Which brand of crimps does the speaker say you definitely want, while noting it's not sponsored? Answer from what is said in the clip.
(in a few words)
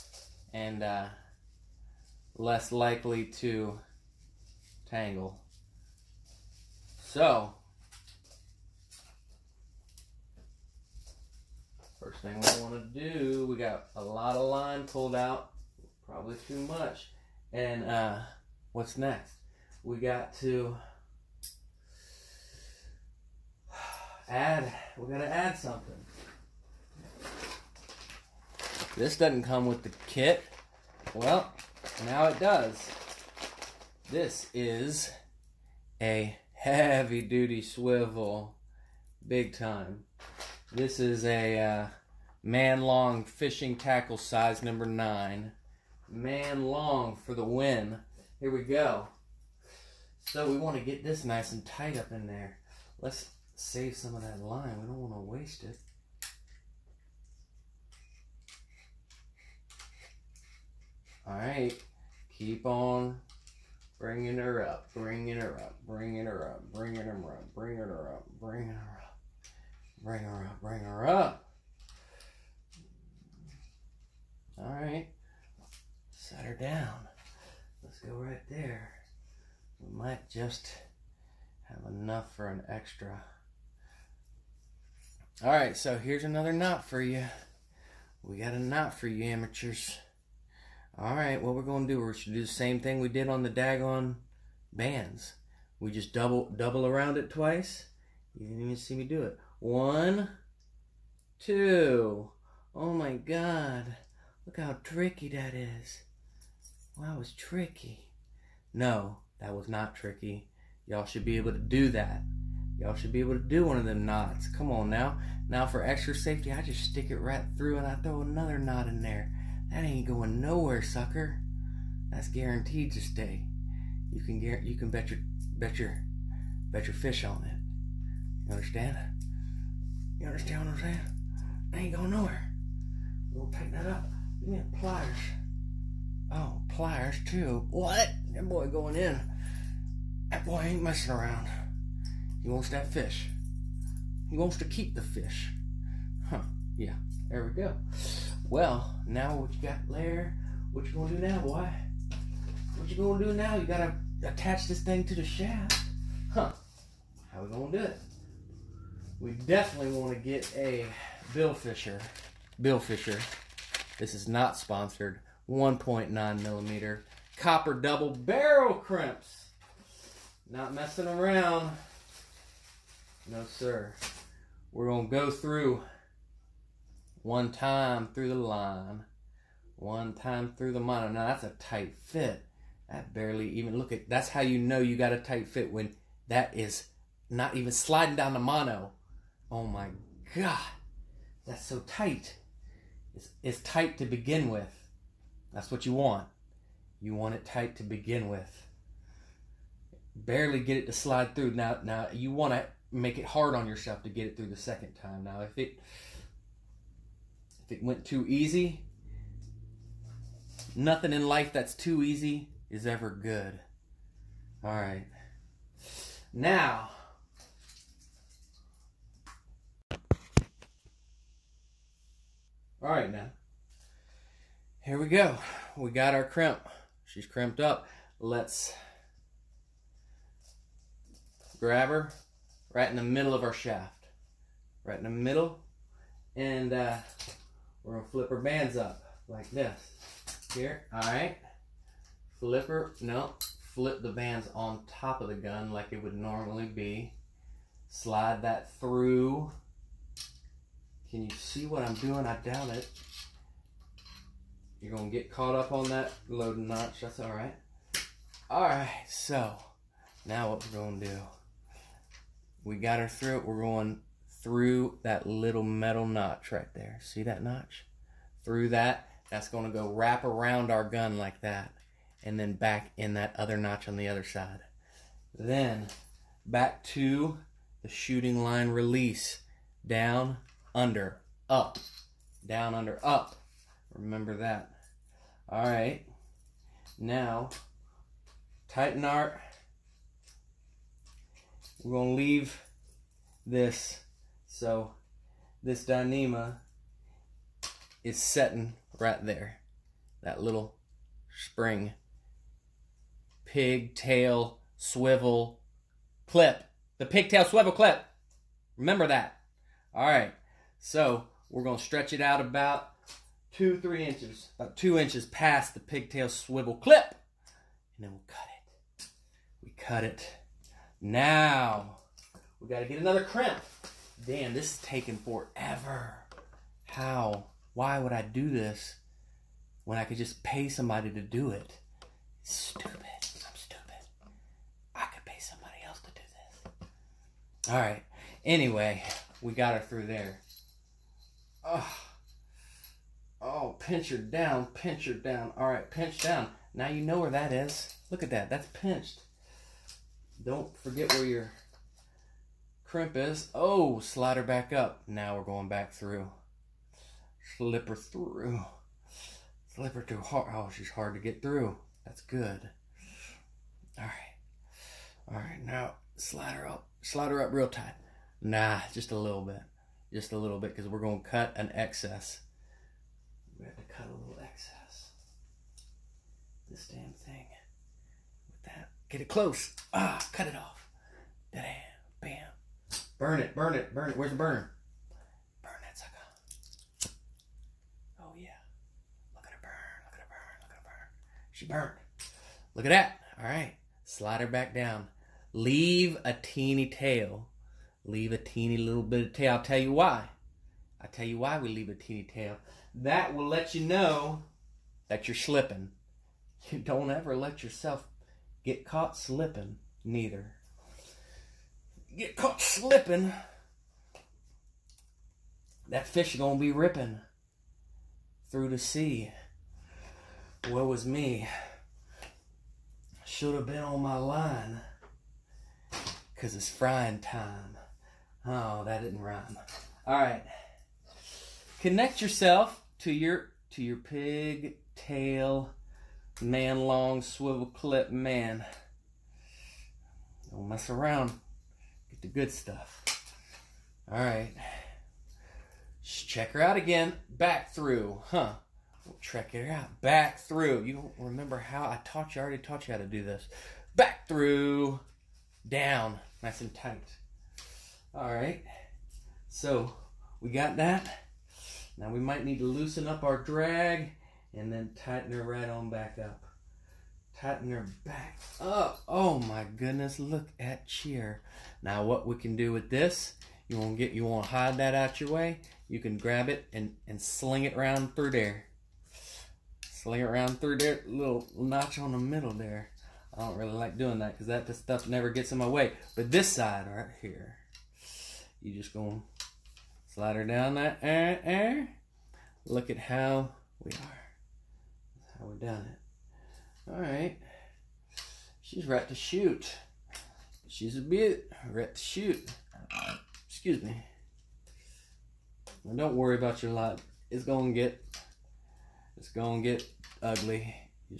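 Billfisher.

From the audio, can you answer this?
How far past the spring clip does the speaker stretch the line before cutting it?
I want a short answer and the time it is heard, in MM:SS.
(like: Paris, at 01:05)
about 2 inches, at 05:14.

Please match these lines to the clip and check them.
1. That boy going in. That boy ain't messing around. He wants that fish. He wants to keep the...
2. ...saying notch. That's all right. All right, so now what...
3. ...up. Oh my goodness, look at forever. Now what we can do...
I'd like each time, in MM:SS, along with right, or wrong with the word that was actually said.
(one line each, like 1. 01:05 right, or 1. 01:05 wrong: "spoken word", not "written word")
1. 02:18 right
2. 04:16 wrong: "loading", not "saying"
3. 07:48 wrong: "cheer", not "forever".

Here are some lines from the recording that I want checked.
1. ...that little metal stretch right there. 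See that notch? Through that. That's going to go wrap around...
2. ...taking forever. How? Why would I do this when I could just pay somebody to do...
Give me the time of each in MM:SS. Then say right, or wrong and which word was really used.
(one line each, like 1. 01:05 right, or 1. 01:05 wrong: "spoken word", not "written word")
1. 04:25 wrong: "notch", not "stretch"
2. 05:24 right.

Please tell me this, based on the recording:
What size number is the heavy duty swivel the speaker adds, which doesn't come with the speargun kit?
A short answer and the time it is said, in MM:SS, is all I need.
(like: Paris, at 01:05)
9, at 00:44.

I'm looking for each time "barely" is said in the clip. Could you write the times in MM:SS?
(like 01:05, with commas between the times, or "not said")
03:03, 03:20.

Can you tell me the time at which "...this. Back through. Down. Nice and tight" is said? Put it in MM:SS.
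07:33.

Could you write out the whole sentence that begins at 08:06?
But this side right here, you just going to slide her down that air, eh, air.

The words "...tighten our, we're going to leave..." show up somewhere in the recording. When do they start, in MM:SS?
04:48.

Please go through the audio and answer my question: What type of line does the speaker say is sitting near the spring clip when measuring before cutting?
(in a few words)
Dyneema.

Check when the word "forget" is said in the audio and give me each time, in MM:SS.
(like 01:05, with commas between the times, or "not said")
05:50.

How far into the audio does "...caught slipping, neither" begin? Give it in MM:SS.
06:48.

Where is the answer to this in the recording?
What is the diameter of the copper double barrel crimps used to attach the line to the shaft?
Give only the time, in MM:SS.
02:45.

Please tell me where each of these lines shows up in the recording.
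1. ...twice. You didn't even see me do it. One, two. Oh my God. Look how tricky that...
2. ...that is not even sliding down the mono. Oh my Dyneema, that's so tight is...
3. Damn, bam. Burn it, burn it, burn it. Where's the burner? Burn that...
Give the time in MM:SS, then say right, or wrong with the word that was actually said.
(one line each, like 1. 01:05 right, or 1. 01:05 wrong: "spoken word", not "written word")
1. 01:37 right
2. 03:06 wrong: "God", not "Dyneema"
3. 06:21 right.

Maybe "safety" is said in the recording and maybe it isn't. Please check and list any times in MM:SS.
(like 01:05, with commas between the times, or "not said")
01:56.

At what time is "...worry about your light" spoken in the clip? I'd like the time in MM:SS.
08:26.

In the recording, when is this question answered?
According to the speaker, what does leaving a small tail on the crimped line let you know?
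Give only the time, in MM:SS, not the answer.
06:45.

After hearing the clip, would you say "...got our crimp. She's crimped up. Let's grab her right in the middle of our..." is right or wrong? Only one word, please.
right.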